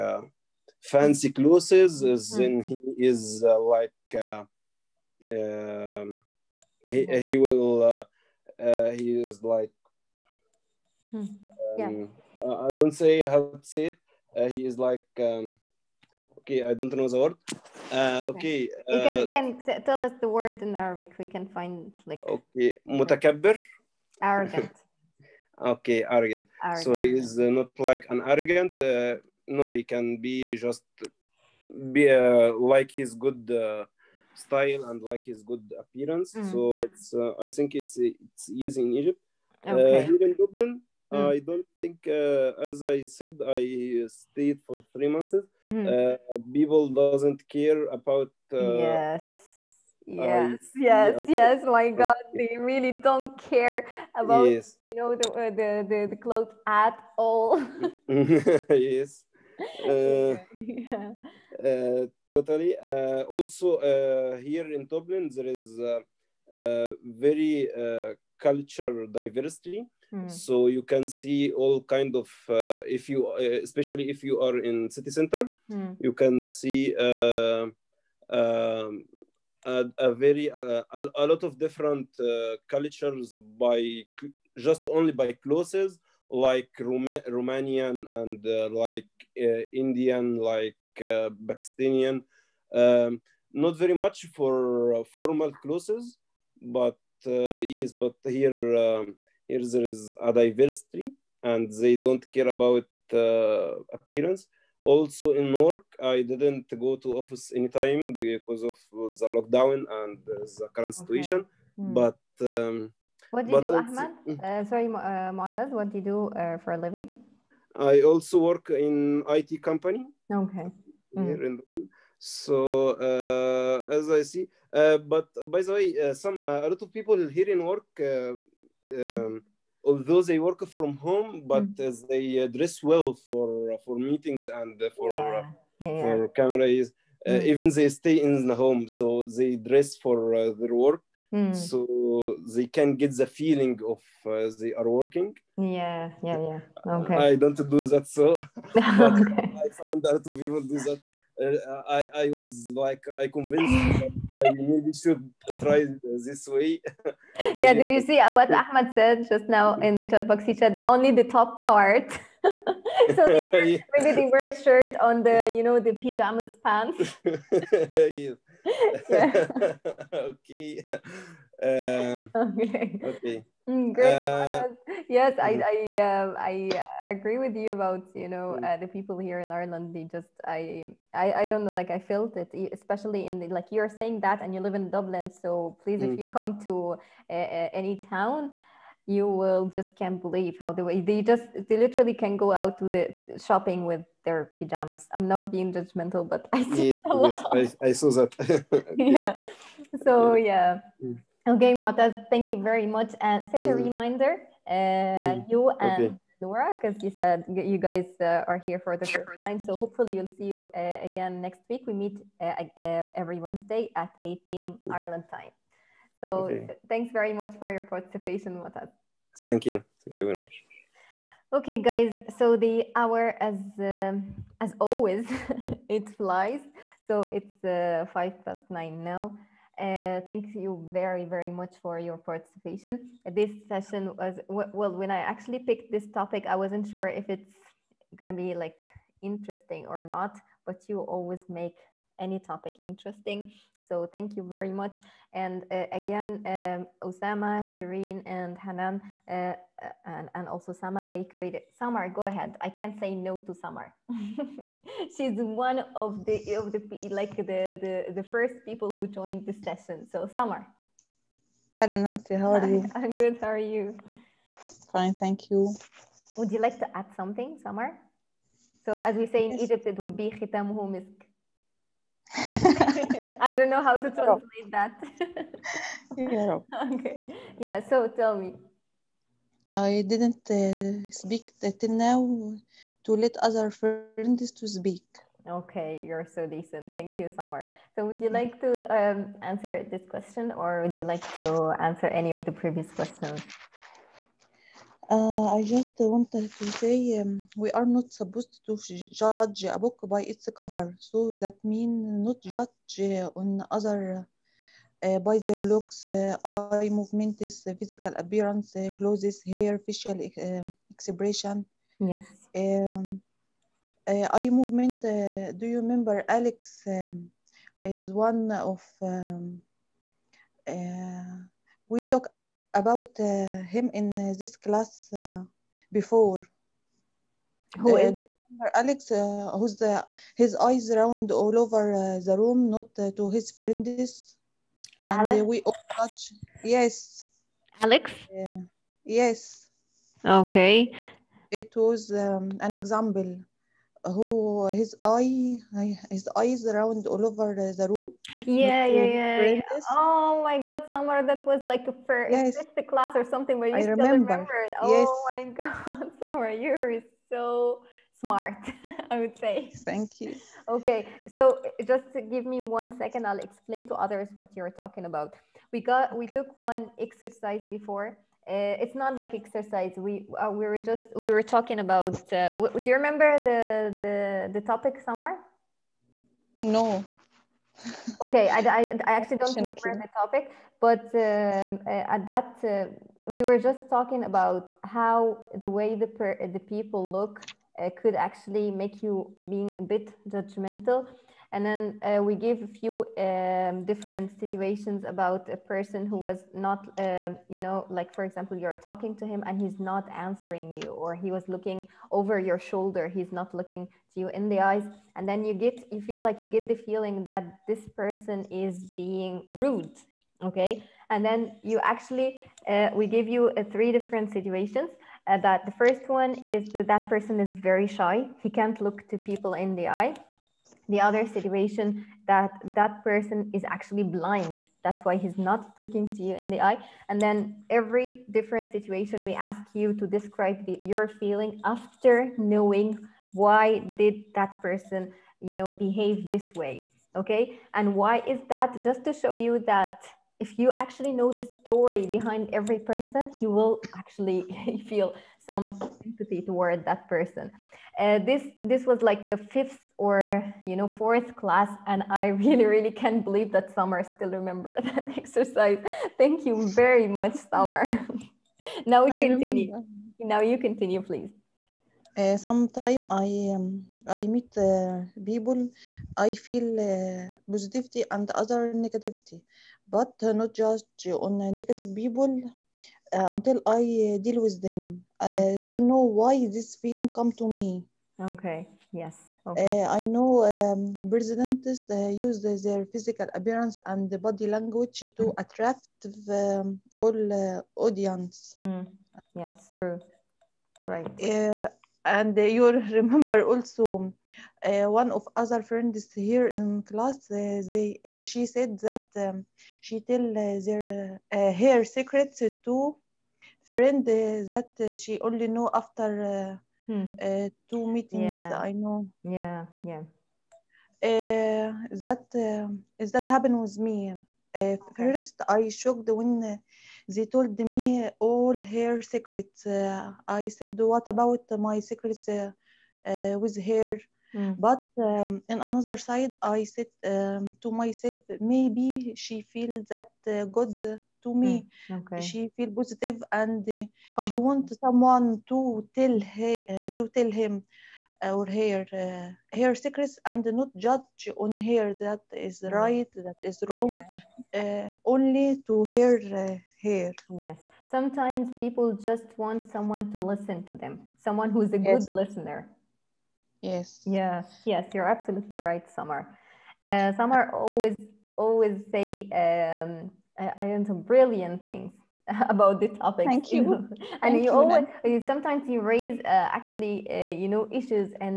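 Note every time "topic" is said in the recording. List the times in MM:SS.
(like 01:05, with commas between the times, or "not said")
03:56, 04:02, 06:14, 06:20, 09:22.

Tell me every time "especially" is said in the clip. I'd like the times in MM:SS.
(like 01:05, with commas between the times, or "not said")
01:13, 03:02.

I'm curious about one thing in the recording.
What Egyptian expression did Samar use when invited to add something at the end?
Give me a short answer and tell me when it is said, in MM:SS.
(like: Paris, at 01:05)
khitamuhu misk, at 04:30.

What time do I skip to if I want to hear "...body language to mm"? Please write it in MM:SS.
08:04.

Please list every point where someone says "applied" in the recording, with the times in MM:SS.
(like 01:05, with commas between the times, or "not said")
not said.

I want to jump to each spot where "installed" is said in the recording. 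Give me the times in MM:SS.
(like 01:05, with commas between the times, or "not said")
not said.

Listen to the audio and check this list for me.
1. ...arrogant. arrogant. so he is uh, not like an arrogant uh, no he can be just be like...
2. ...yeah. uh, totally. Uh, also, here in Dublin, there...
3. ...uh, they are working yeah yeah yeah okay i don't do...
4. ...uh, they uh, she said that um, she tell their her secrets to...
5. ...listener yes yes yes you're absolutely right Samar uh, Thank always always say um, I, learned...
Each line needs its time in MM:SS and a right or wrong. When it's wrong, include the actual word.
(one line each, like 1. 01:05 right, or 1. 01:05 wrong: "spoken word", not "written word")
1. 00:26 right
2. 01:00 right
3. 02:24 right
4. 08:17 right
5. 09:12 wrong: "Samar", not "Thank".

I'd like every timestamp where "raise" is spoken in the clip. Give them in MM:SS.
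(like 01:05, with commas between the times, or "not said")
09:25.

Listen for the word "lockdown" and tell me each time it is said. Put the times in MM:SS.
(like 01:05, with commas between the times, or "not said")
01:49.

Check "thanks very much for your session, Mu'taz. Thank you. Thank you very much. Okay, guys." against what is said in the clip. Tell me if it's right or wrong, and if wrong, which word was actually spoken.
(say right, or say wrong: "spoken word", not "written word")
wrong: "participation", not "session".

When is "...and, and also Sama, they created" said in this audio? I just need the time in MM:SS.
04:10.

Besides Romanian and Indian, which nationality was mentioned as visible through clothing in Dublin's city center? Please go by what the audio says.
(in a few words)
Pakistani.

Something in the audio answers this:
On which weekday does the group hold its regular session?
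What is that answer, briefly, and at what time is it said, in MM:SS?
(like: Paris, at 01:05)
Wednesday, at 03:33.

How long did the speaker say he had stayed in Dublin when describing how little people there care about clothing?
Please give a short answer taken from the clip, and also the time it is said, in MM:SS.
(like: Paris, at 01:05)
3 months, at 00:44.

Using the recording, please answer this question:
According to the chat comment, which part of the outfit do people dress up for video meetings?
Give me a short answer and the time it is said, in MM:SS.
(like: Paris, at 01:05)
the top part, at 02:40.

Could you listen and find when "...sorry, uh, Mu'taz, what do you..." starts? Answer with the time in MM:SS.
01:54.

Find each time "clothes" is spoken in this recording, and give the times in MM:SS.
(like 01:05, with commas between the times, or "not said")
00:01, 00:56, 01:25, 01:35, 05:08.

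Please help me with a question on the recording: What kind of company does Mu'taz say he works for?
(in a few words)
IT company.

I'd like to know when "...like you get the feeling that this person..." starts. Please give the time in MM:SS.
06:46.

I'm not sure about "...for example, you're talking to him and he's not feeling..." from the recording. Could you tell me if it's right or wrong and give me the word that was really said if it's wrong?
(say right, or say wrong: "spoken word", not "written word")
wrong: "answering", not "feeling".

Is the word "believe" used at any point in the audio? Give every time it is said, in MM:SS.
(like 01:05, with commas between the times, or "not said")
03:10, 07:33.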